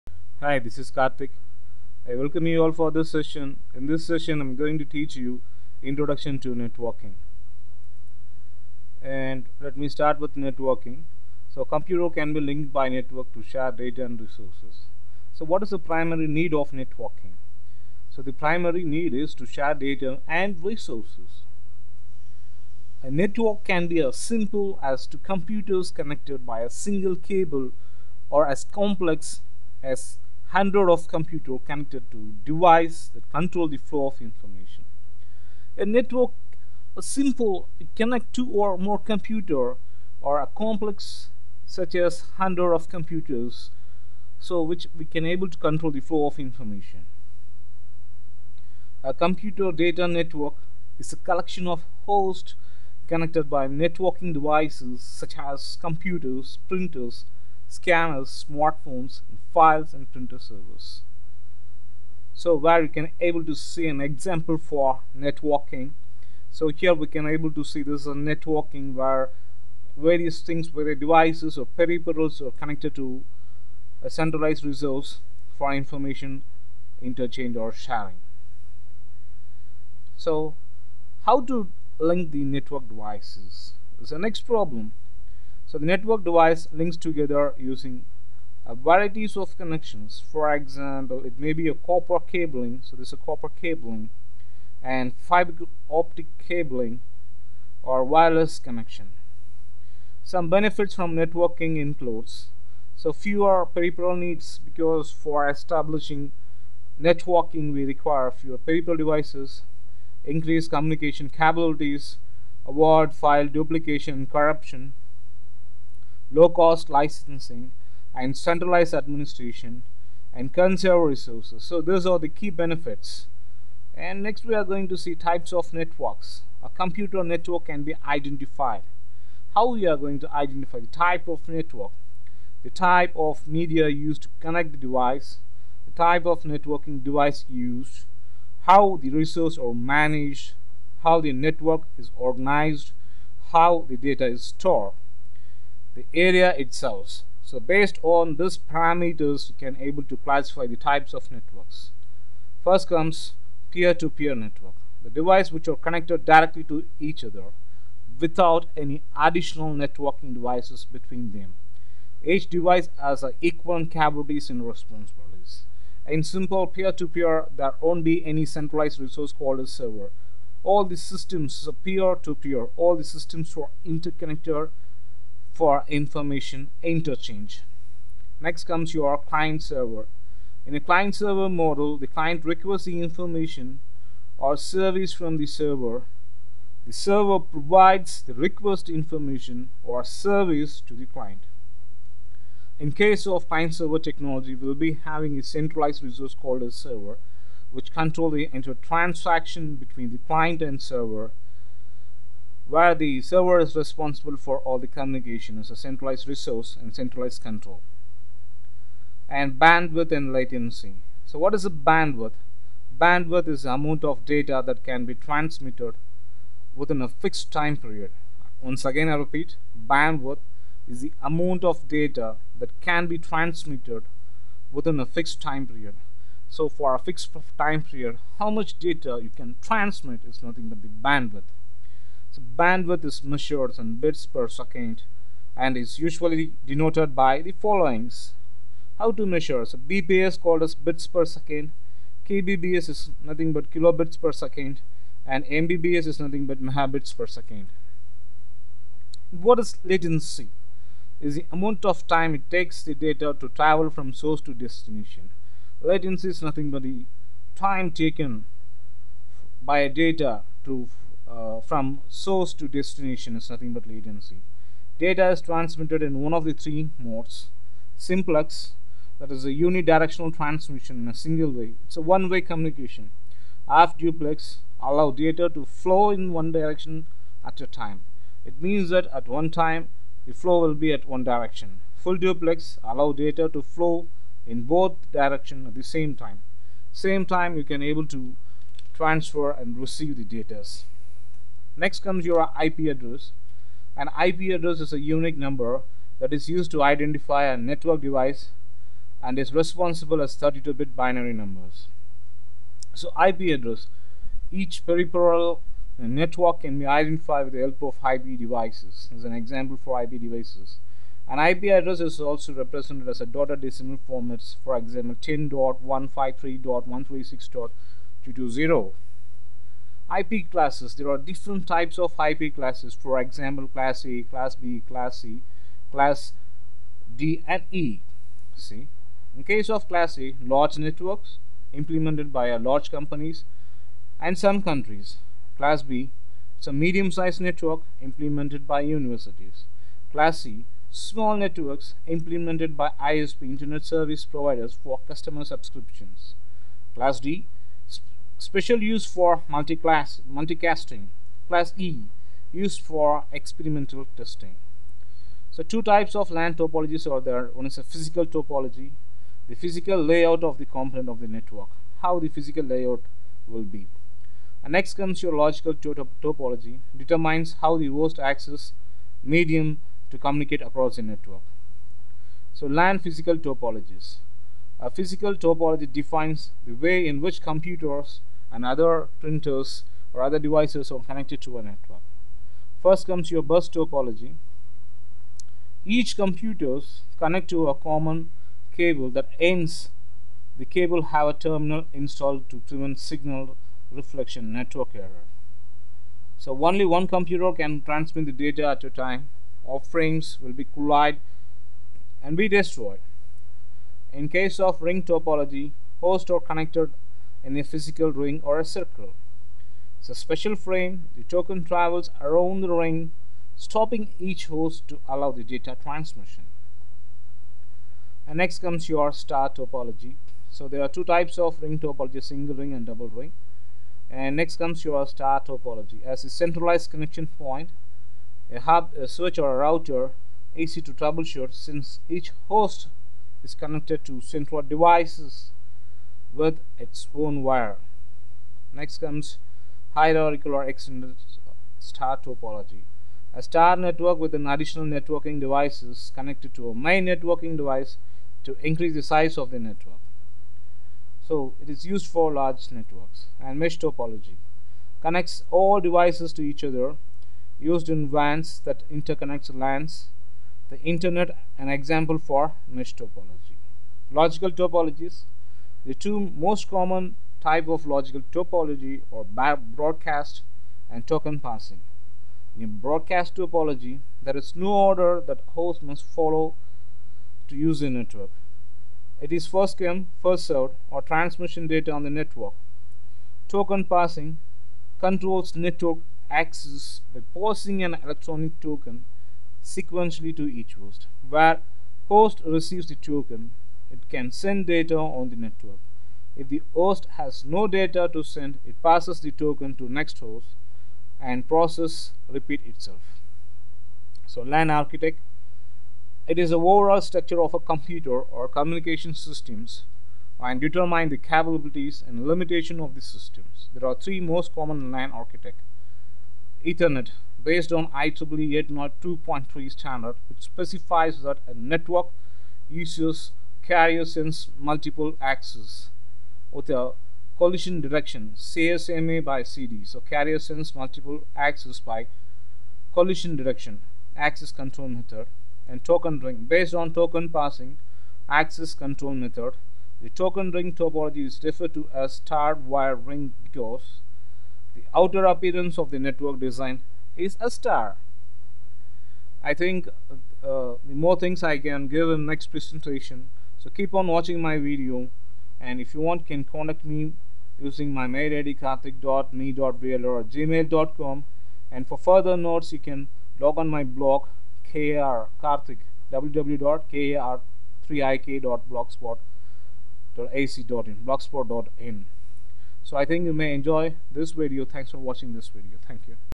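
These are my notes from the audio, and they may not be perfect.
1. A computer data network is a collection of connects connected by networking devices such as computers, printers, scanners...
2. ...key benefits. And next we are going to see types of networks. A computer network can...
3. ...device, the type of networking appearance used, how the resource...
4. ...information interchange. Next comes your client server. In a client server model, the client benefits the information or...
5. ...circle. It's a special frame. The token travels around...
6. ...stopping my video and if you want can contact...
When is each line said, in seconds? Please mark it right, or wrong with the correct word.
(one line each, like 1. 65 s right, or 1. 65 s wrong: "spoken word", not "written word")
1. 49 s wrong: "hosts", not "connects"
2. 122 s right
3. 134 s wrong: "device", not "appearance"
4. 175 s wrong: "requests", not "benefits"
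5. 408 s right
6. 554 s wrong: "watching", not "stopping".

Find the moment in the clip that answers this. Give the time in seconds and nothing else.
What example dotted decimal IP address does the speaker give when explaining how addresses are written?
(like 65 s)
315 s.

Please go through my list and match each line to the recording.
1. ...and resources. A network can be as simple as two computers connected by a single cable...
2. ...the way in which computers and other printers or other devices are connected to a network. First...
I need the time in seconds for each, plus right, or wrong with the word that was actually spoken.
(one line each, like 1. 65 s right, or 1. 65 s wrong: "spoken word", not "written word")
1. 20 s right
2. 376 s right.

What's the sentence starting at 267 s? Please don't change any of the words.
Simplex, that is a unidirectional transmission in a single way.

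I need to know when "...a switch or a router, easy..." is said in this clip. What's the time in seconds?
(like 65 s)
428 s.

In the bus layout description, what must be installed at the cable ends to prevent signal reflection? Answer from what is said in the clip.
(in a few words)
a terminal.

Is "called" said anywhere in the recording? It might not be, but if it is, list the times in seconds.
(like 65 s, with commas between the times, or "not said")
169 s, 196 s, 240 s.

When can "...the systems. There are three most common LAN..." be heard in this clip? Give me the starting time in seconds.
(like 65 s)
512 s.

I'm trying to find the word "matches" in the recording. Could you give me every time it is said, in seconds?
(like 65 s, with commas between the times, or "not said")
not said.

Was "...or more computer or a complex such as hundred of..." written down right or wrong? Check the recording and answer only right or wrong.
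right.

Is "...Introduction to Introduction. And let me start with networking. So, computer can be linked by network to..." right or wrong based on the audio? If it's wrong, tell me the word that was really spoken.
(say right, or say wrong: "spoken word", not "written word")
wrong: "Networking", not "Introduction".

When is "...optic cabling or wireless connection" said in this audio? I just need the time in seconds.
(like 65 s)
95 s.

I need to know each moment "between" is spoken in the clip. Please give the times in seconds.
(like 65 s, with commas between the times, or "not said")
160 s, 199 s.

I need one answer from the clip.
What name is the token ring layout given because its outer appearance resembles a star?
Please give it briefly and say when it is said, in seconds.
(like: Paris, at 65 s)
starred wire ring, at 542 s.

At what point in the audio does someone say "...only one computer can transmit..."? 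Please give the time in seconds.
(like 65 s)
396 s.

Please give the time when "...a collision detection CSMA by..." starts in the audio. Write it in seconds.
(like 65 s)
526 s.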